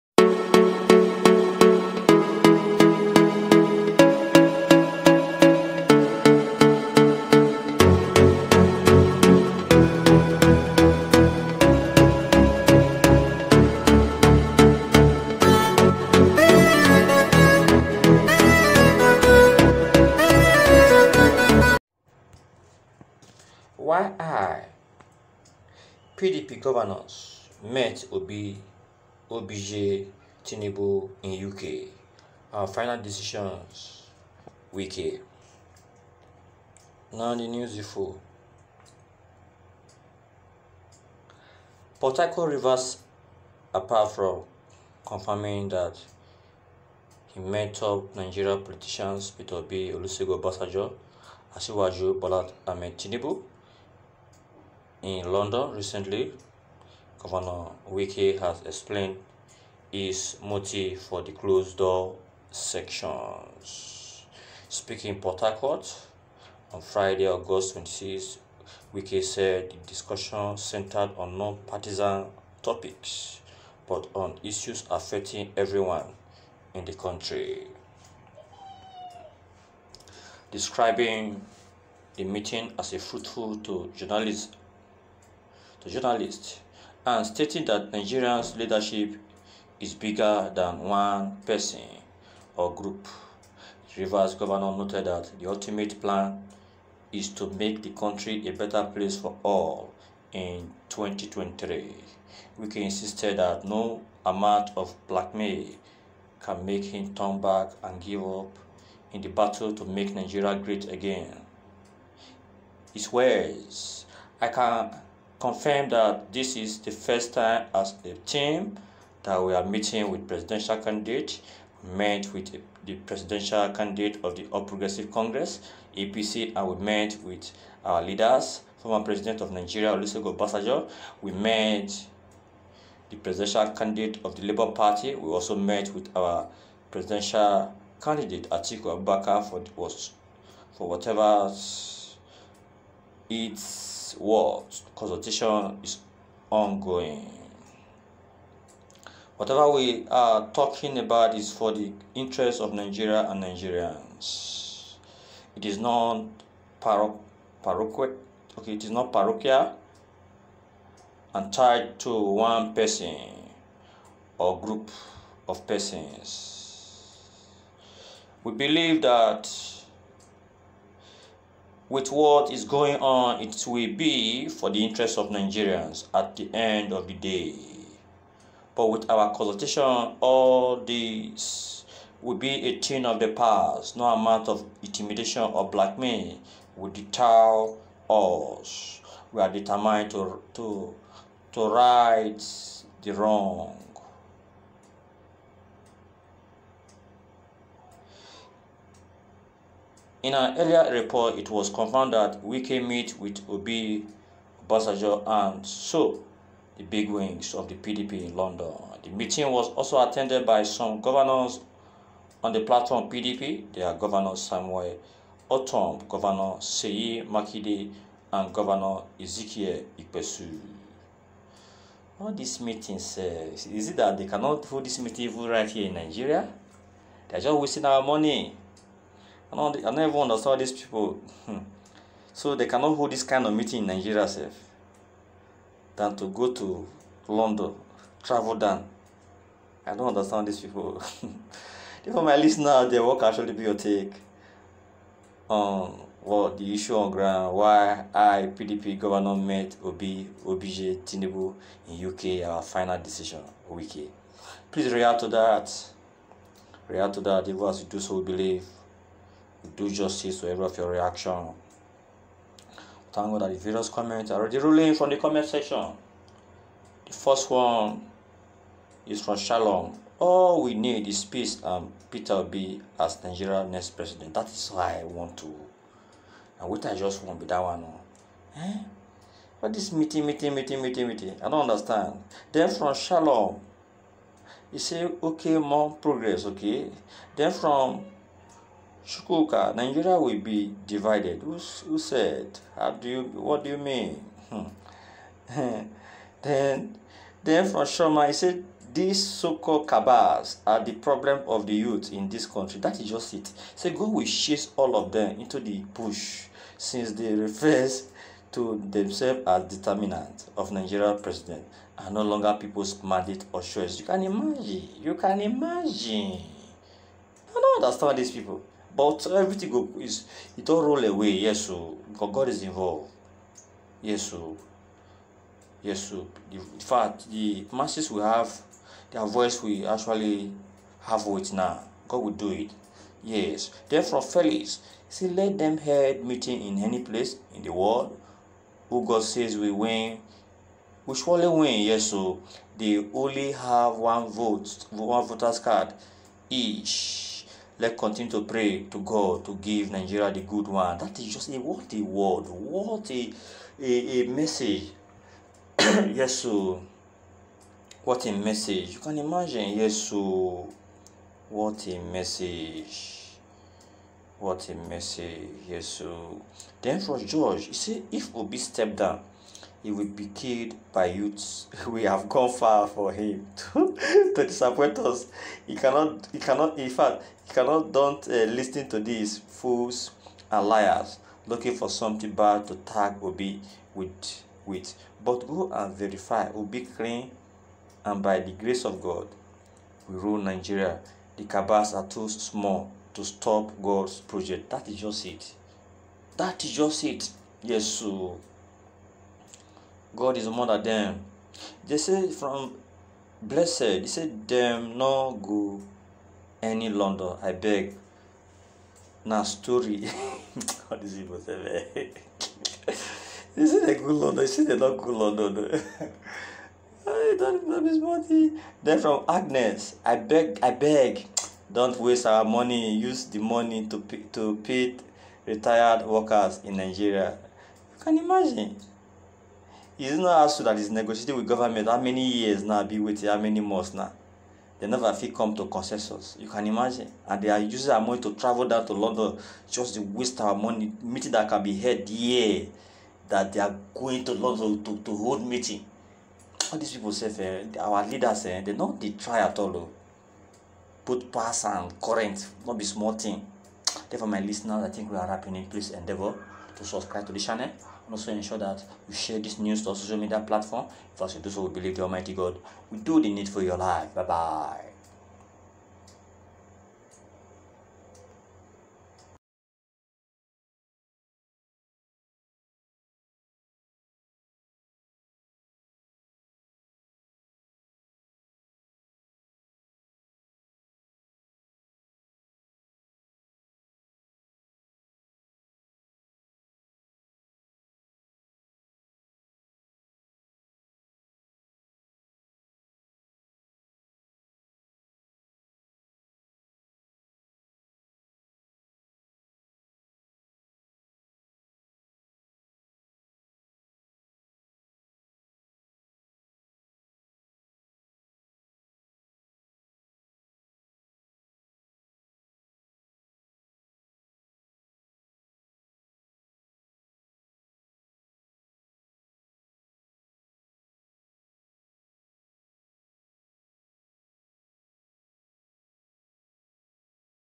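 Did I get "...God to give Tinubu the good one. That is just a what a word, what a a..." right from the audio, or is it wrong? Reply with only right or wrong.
wrong.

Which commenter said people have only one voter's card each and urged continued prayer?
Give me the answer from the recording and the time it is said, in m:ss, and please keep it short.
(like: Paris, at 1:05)
Felix, at 5:34.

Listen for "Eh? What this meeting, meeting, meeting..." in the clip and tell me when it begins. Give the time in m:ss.
4:38.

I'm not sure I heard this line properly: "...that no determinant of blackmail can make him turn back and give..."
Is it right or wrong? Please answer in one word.
wrong.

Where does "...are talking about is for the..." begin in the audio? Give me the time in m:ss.
2:30.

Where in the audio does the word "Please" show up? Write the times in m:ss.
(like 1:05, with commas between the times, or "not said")
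4:14, 7:35.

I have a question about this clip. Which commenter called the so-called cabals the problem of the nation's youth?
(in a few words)
Sharma.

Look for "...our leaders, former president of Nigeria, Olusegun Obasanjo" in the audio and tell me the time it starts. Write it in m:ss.
2:07.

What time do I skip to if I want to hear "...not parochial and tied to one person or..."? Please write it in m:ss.
2:38.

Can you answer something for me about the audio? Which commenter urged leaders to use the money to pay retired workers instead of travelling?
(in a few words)
Agnes.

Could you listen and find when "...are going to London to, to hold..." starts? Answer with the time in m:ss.
7:23.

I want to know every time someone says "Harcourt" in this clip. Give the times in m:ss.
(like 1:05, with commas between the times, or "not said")
0:42, 1:05.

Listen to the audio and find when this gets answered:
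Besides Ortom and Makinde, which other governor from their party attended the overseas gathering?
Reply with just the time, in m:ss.
3:38.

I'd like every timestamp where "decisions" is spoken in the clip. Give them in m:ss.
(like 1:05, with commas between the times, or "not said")
0:33, 4:12.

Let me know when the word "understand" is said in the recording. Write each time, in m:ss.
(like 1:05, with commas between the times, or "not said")
3:50, 4:00, 4:41, 5:17.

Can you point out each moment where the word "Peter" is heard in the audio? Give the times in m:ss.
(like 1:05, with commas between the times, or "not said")
0:49, 4:32.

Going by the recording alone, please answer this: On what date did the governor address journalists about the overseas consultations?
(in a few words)
August 26.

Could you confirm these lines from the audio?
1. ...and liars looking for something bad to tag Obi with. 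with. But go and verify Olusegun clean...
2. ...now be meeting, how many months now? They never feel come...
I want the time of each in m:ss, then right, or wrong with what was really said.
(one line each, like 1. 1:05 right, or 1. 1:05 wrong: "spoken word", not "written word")
1. 6:20 wrong: "Obi", not "Olusegun"
2. 7:12 wrong: "waiting", not "meeting".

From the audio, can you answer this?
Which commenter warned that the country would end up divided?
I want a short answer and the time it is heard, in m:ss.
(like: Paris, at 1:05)
Shukuka, at 4:49.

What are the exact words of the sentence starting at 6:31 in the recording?
The cabals are too small to stop God's project.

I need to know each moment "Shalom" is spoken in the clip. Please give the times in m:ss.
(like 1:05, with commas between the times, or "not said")
4:29, 4:42.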